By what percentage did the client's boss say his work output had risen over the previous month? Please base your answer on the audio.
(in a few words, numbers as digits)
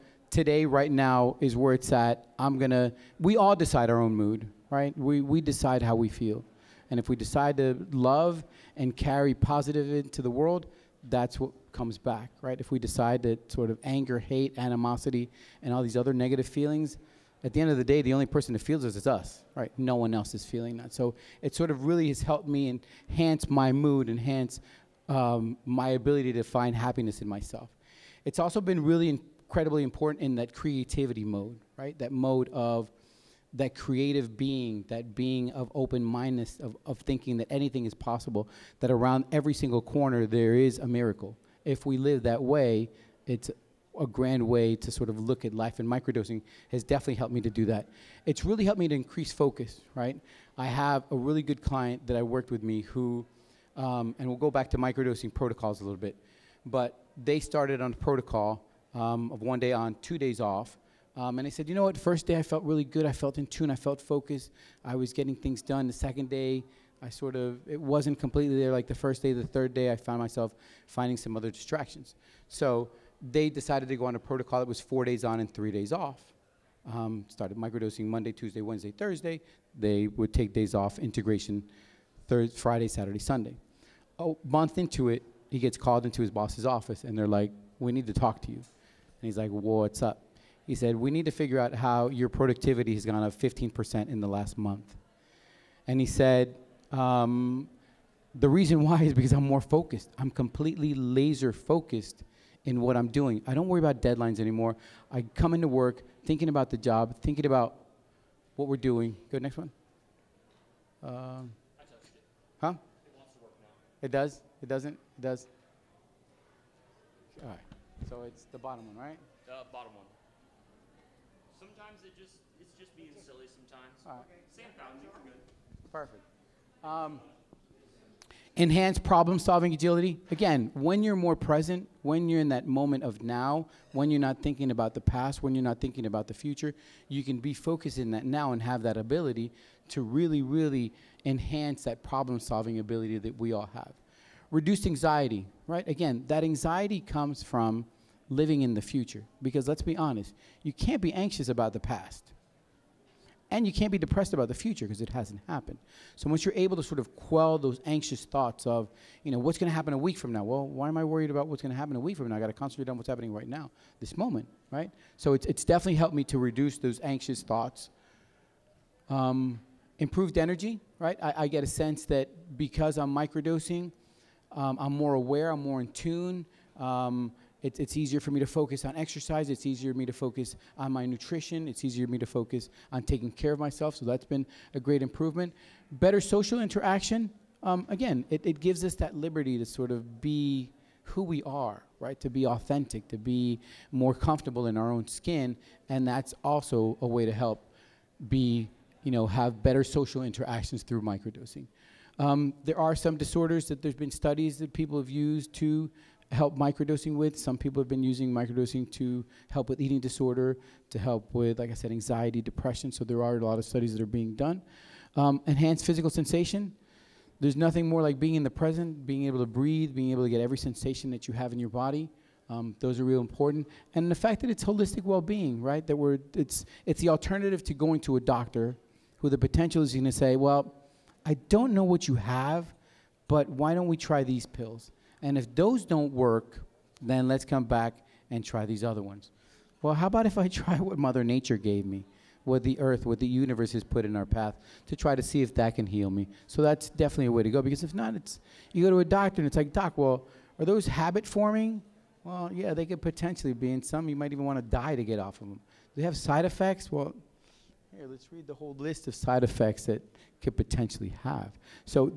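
15%.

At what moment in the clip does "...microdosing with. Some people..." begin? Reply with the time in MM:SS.
03:26.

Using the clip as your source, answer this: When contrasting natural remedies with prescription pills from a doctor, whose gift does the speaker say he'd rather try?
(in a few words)
Mother Nature.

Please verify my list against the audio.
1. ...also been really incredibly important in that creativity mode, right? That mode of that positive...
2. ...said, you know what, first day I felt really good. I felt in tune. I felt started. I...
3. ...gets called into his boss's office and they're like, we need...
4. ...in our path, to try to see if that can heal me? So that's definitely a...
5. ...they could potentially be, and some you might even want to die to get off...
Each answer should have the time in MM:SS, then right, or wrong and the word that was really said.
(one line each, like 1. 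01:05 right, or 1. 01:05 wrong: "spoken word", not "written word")
1. 00:28 wrong: "creative", not "positive"
2. 01:01 wrong: "focused", not "started"
3. 01:25 right
4. 04:04 right
5. 04:12 right.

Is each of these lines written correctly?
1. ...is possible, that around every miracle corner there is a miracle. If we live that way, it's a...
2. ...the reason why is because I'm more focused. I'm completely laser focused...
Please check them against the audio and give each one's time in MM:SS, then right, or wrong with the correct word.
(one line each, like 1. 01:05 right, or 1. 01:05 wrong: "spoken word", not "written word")
1. 00:37 wrong: "single", not "miracle"
2. 01:38 right.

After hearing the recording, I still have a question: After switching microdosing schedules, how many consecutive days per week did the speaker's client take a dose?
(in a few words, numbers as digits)
4.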